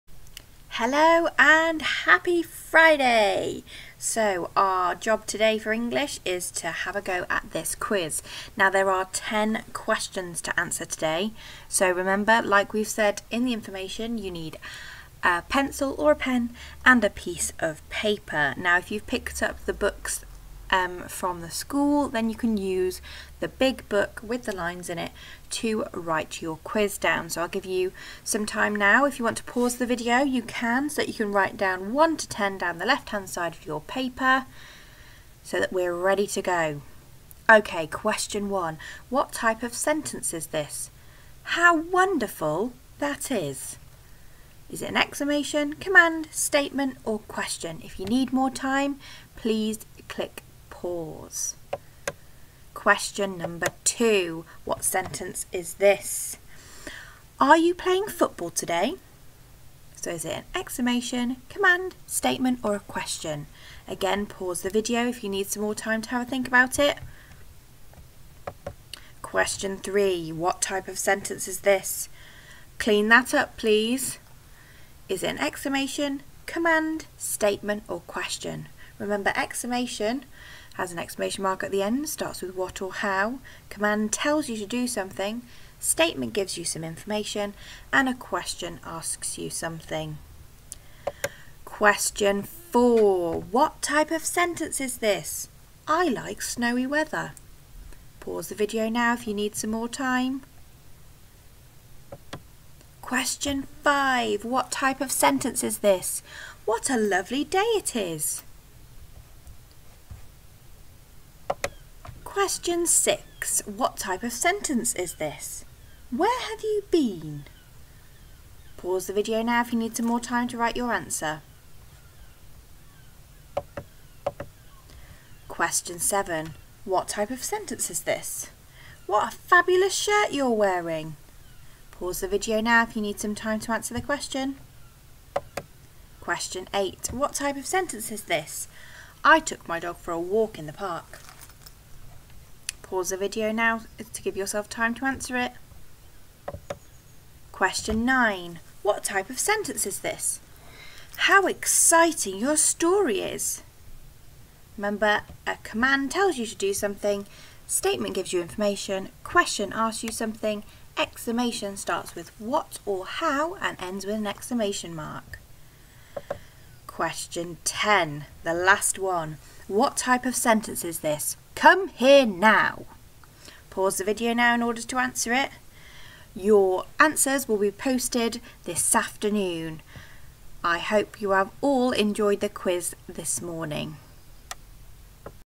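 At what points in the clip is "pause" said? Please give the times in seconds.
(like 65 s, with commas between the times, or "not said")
29 s, 50 s, 64 s, 98 s, 118 s, 131 s, 142 s, 173 s.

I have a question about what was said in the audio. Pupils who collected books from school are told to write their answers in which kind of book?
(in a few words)
the big book with the lines.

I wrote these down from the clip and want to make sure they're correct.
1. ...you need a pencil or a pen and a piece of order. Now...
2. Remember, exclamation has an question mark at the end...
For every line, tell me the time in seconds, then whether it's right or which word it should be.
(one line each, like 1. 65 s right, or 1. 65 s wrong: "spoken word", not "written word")
1. 14 s wrong: "paper", not "order"
2. 78 s wrong: "exclamation", not "question".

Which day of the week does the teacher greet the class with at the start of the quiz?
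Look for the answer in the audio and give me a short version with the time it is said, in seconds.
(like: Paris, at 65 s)
Friday, at 2 s.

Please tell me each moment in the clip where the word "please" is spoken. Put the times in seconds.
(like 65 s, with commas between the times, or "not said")
49 s, 73 s.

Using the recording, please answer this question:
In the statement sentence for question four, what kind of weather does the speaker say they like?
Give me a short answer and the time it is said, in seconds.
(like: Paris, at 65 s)
snowy weather, at 96 s.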